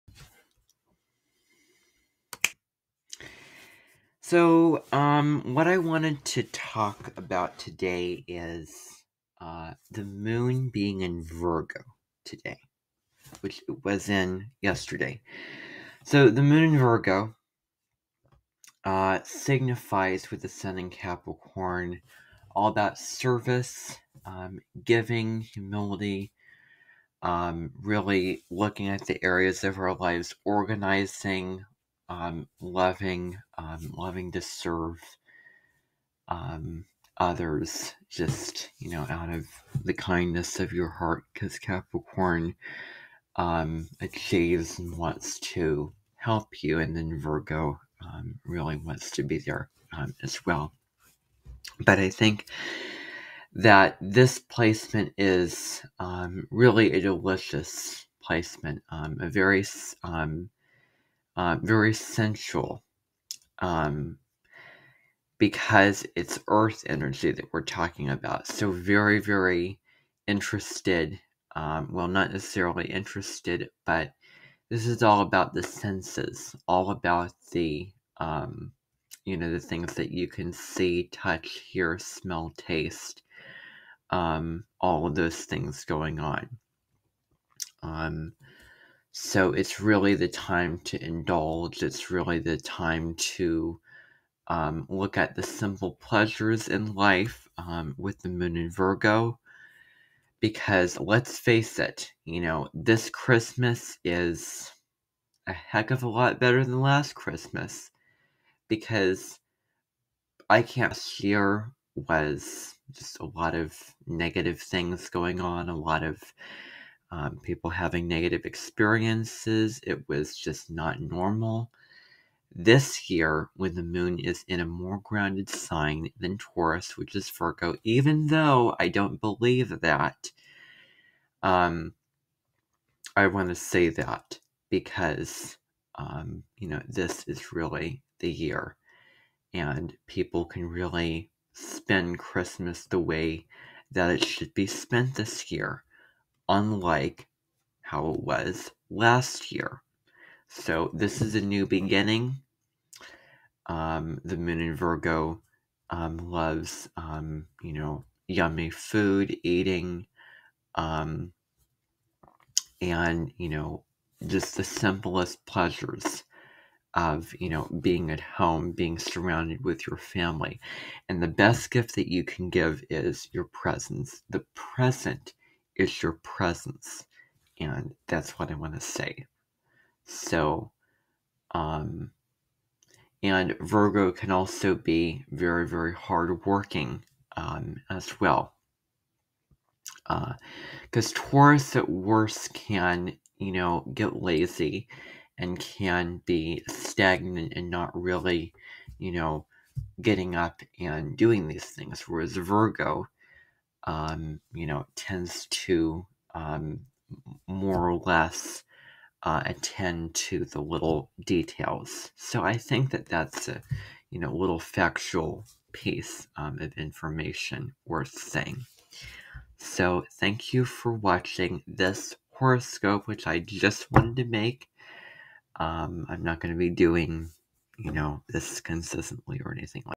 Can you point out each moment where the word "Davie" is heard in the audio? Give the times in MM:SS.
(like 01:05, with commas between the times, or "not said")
not said.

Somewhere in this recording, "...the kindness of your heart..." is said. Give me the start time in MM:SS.
00:39.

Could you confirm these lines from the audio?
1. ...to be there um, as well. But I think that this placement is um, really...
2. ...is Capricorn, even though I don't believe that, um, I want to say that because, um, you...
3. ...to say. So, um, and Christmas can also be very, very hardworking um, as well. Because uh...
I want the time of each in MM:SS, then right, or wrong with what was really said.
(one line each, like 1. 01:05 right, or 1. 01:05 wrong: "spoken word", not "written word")
1. 00:49 right
2. 02:07 wrong: "Virgo", not "Capricorn"
3. 02:58 wrong: "Virgo", not "Christmas".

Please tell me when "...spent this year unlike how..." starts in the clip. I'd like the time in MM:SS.
02:24.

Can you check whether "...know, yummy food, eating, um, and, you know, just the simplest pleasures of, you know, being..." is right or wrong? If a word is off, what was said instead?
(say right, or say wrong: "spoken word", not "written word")
right.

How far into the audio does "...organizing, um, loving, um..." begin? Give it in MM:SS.
00:30.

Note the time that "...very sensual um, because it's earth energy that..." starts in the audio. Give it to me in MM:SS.
01:01.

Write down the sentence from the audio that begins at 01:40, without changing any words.
Because let's face it, you know, this Christmas is a heck of a lot better than last Christmas.